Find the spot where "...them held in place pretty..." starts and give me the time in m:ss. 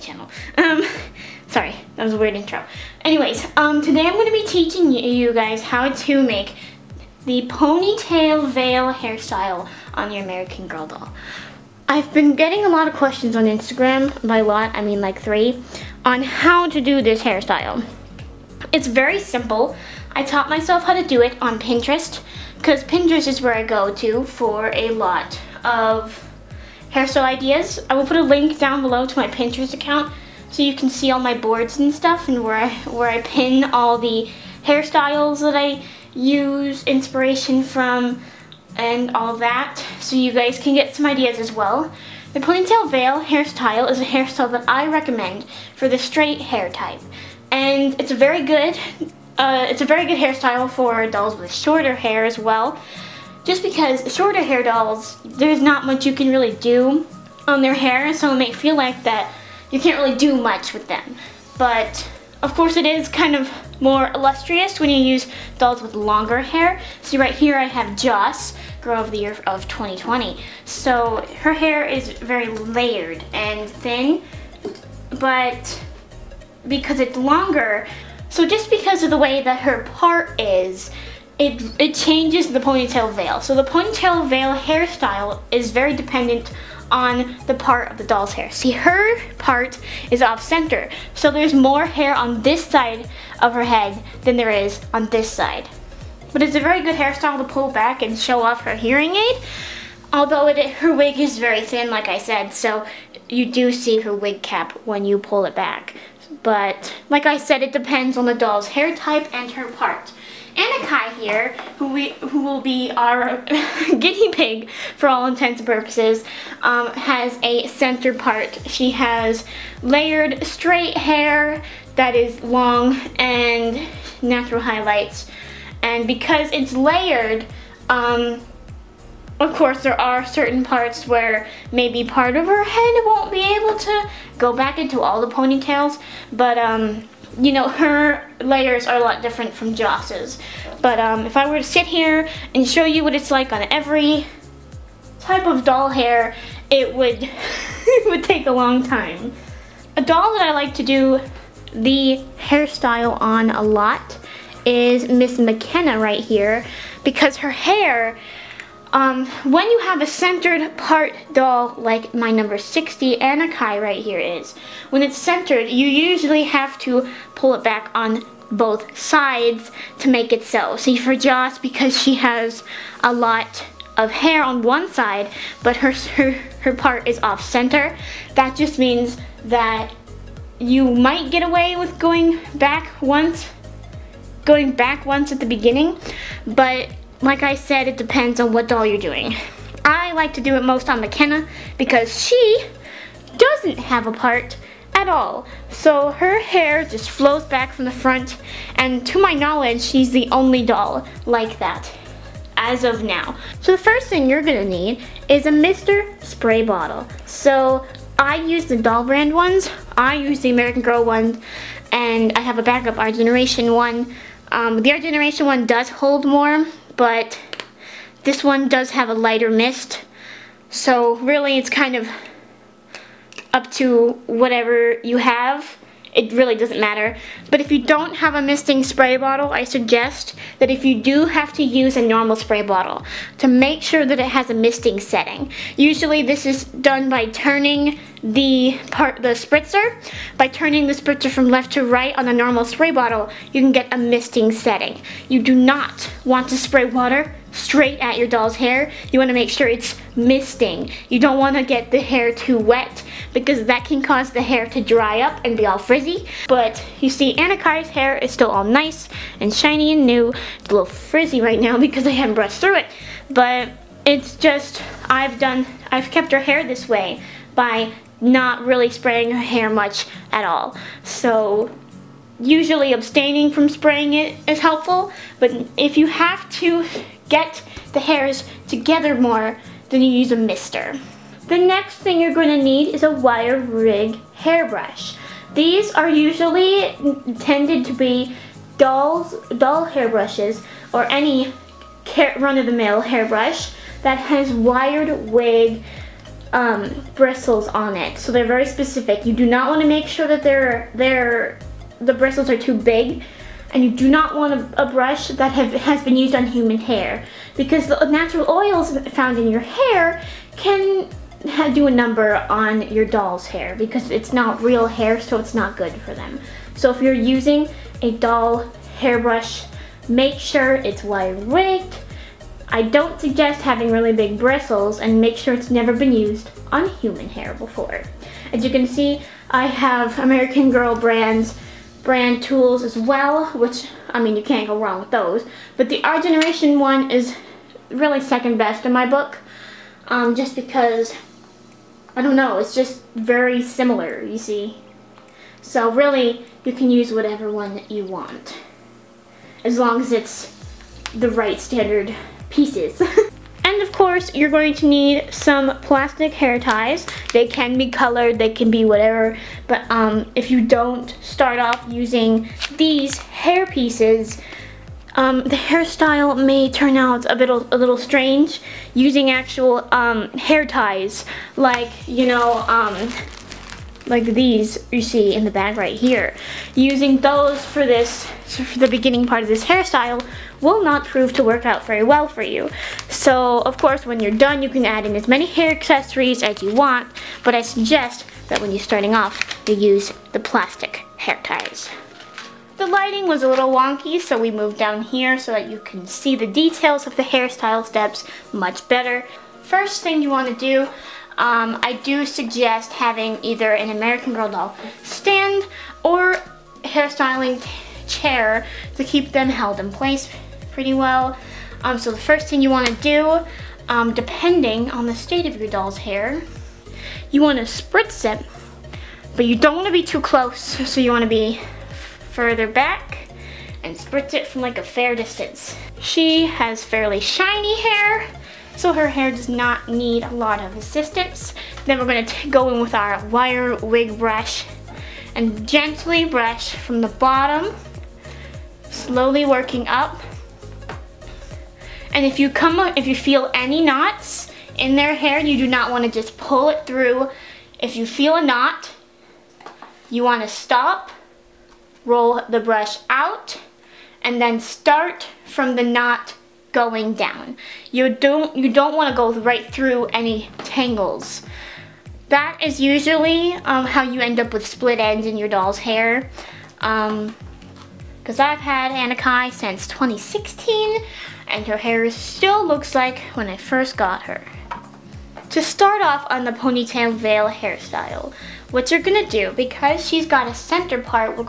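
6:49.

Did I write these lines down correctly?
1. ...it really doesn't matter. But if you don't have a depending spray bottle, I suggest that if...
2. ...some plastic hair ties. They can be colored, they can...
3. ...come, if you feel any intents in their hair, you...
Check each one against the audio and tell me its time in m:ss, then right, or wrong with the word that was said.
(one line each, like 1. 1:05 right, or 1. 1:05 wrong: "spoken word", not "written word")
1. 3:46 wrong: "misting", not "depending"
2. 5:55 right
3. 7:22 wrong: "knots", not "intents".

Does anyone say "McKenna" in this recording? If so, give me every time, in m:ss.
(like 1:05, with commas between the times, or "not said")
2:35, 3:11.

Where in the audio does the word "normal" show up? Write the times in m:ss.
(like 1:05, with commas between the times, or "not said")
3:52, 4:02.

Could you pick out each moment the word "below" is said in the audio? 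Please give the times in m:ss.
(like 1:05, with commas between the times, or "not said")
0:28.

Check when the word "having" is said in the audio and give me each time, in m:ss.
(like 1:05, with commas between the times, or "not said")
5:23, 6:42.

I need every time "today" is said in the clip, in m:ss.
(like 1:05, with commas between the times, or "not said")
0:03.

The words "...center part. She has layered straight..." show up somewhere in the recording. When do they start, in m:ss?
1:57.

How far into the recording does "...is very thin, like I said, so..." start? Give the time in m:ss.
1:41.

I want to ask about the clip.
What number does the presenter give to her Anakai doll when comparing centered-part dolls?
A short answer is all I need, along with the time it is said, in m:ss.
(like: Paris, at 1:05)
60, at 2:42.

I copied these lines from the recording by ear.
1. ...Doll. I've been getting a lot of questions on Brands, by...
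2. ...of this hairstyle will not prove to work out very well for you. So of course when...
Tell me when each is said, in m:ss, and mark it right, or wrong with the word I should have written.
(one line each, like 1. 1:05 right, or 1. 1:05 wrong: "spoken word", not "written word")
1. 0:10 wrong: "Instagram", not "Brands"
2. 6:19 right.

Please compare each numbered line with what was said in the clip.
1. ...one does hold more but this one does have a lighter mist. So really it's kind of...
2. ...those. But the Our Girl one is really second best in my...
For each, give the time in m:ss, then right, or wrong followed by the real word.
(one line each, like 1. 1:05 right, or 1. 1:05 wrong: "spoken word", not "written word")
1. 3:35 right
2. 5:35 wrong: "Generation", not "Girl".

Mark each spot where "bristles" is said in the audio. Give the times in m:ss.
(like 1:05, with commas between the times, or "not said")
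4:57, 5:02, 5:24.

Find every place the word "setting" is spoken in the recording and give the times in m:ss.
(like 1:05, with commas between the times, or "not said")
3:55, 4:04.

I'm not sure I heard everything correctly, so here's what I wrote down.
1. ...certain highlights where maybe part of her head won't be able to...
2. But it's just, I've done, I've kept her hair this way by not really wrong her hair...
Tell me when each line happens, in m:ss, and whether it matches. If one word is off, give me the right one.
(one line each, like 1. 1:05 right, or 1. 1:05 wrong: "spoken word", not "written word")
1. 2:10 wrong: "parts", not "highlights"
2. 4:23 wrong: "spraying", not "wrong".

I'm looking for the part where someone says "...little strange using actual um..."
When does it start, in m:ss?
6:07.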